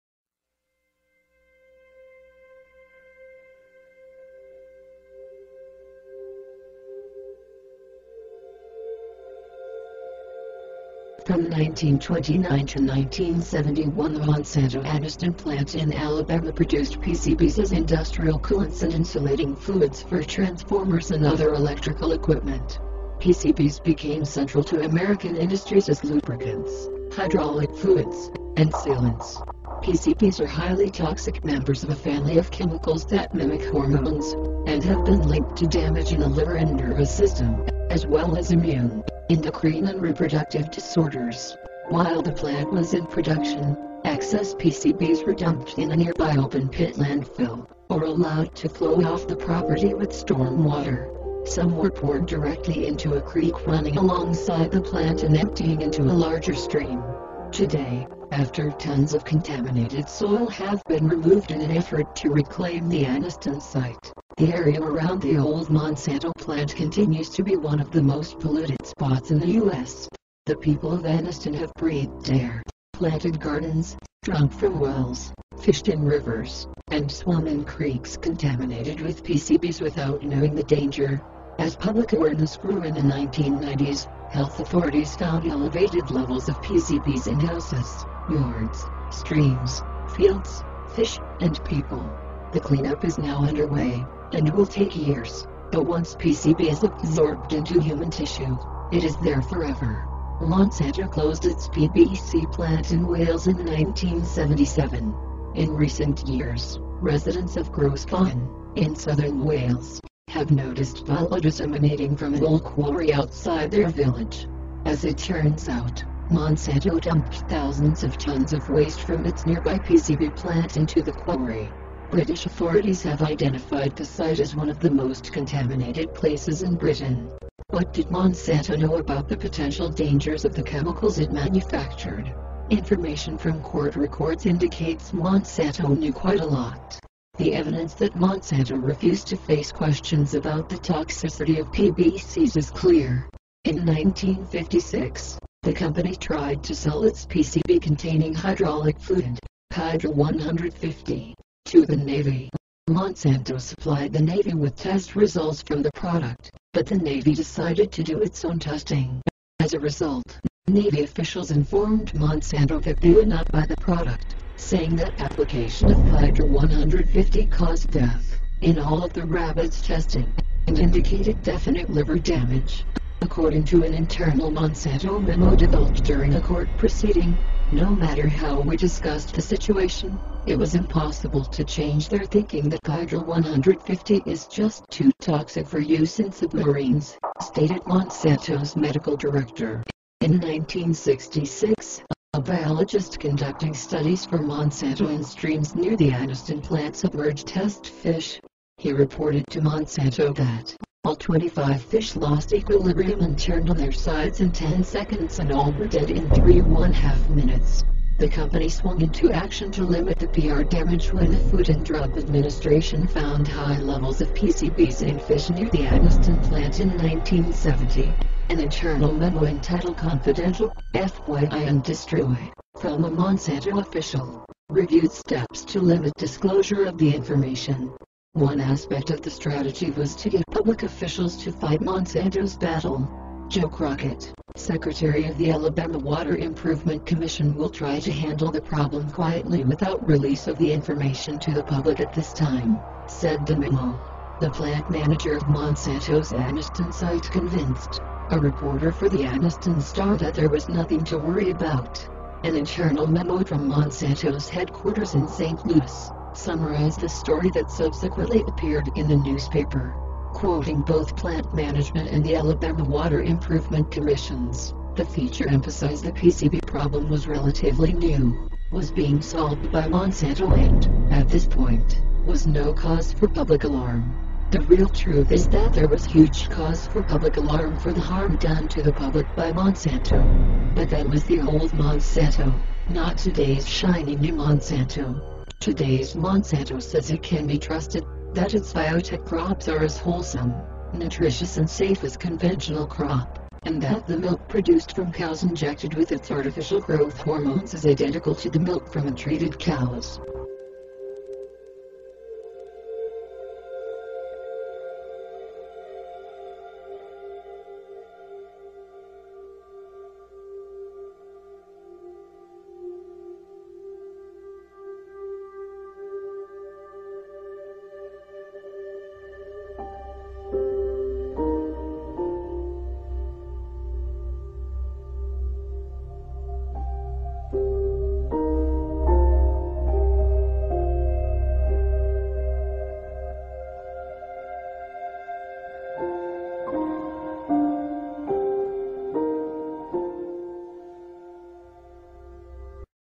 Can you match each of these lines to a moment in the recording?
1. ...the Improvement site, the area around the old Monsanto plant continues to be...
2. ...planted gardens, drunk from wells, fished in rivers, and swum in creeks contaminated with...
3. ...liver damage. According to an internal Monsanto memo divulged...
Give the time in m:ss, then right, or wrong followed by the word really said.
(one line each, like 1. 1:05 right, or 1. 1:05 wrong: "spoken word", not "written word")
1. 1:02 wrong: "Anniston", not "Improvement"
2. 1:12 right
3. 2:51 right.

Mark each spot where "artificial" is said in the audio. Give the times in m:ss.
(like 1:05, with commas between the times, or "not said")
4:56.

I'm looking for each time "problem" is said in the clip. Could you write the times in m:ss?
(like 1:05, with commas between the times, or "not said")
3:58, 4:26.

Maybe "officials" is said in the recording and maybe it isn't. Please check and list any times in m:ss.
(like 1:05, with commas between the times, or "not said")
2:41, 3:43, 3:50.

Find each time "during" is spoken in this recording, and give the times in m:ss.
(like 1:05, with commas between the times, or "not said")
2:56.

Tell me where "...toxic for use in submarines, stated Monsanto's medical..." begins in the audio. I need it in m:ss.
3:05.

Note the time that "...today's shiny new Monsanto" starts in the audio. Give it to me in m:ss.
4:43.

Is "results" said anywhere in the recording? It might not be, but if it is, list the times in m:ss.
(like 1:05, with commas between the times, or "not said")
2:35, 2:39.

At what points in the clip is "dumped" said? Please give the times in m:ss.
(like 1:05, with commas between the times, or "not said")
0:45, 1:57.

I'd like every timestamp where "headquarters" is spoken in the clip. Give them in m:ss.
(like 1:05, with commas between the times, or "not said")
4:14.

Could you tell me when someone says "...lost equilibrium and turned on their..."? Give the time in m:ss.
3:22.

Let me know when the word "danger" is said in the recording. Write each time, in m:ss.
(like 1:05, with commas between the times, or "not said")
1:20, 2:09.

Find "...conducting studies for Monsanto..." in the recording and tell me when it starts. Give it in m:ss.
3:13.